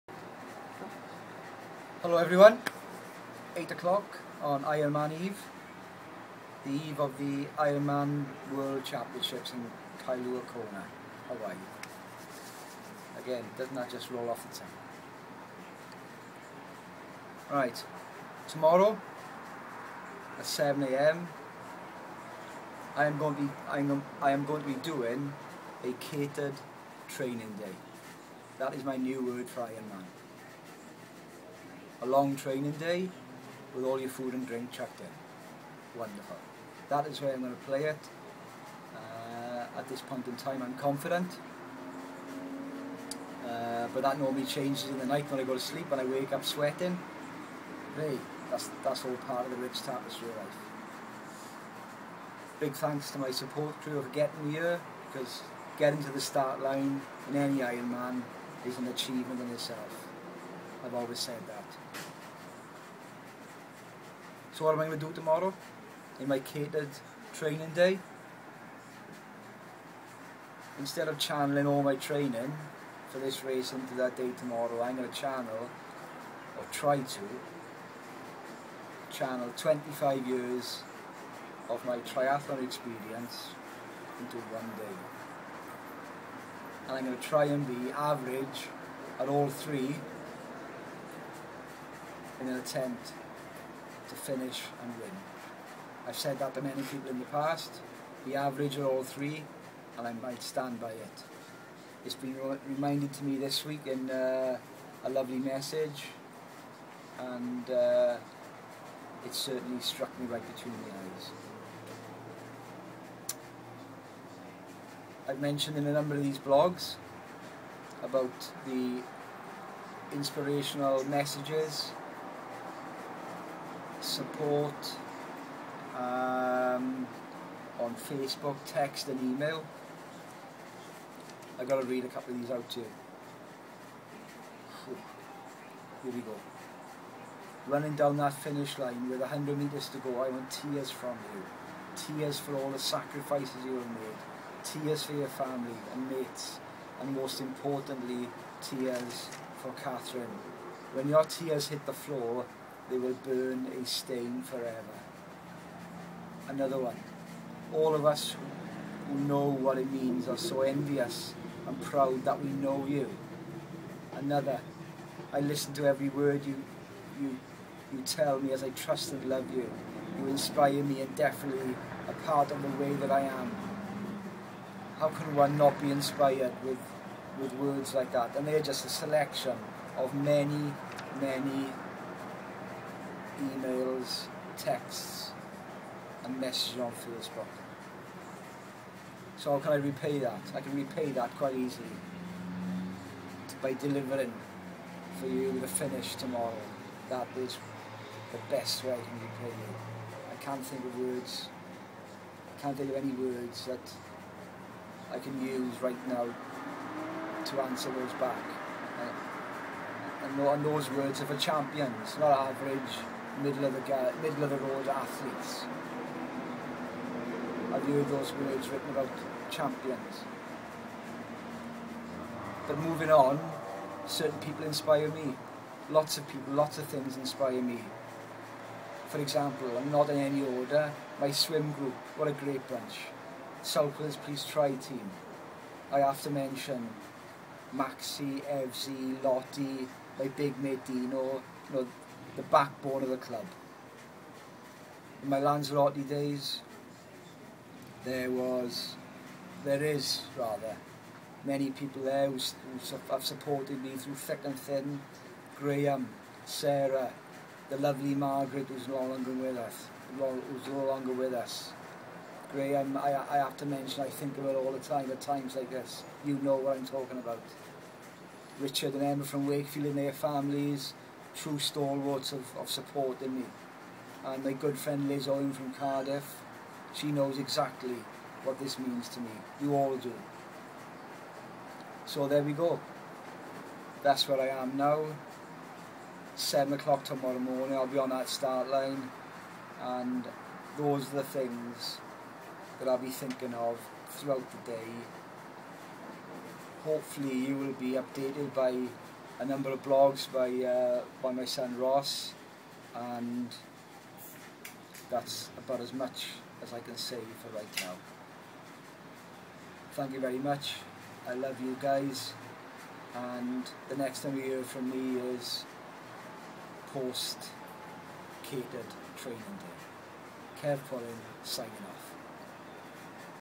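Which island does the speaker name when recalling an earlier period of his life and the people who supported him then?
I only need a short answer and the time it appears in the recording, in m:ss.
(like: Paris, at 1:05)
Lanzarote, at 4:05.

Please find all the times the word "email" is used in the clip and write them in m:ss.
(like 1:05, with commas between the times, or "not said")
2:09, 3:03.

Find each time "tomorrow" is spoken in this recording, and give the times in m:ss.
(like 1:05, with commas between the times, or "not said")
0:18, 1:05, 1:14, 3:16, 4:47.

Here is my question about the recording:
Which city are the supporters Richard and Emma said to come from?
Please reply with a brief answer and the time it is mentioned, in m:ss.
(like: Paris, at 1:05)
Wakefield, at 4:29.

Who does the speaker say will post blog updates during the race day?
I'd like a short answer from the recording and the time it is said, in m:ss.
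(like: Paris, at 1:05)
Ross, at 5:01.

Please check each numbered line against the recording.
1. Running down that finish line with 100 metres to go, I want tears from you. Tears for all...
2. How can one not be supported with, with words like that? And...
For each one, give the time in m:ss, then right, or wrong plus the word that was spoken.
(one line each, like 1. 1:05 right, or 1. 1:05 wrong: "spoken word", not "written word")
1. 2:17 right
2. 2:54 wrong: "inspired", not "supported".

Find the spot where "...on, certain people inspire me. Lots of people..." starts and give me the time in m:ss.
3:43.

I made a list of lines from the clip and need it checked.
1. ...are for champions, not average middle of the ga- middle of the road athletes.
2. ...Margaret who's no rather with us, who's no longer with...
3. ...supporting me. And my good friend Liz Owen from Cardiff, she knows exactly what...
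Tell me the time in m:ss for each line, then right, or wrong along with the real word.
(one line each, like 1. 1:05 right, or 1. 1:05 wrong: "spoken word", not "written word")
1. 3:31 right
2. 4:18 wrong: "longer", not "rather"
3. 4:32 right.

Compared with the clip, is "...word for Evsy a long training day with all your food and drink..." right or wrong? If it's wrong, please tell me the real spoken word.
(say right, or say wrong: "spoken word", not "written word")
wrong: "Ironman", not "Evsy".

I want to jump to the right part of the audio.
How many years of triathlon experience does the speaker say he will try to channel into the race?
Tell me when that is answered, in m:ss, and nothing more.
1:19.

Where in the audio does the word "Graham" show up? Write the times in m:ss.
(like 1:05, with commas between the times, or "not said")
4:15, 4:22.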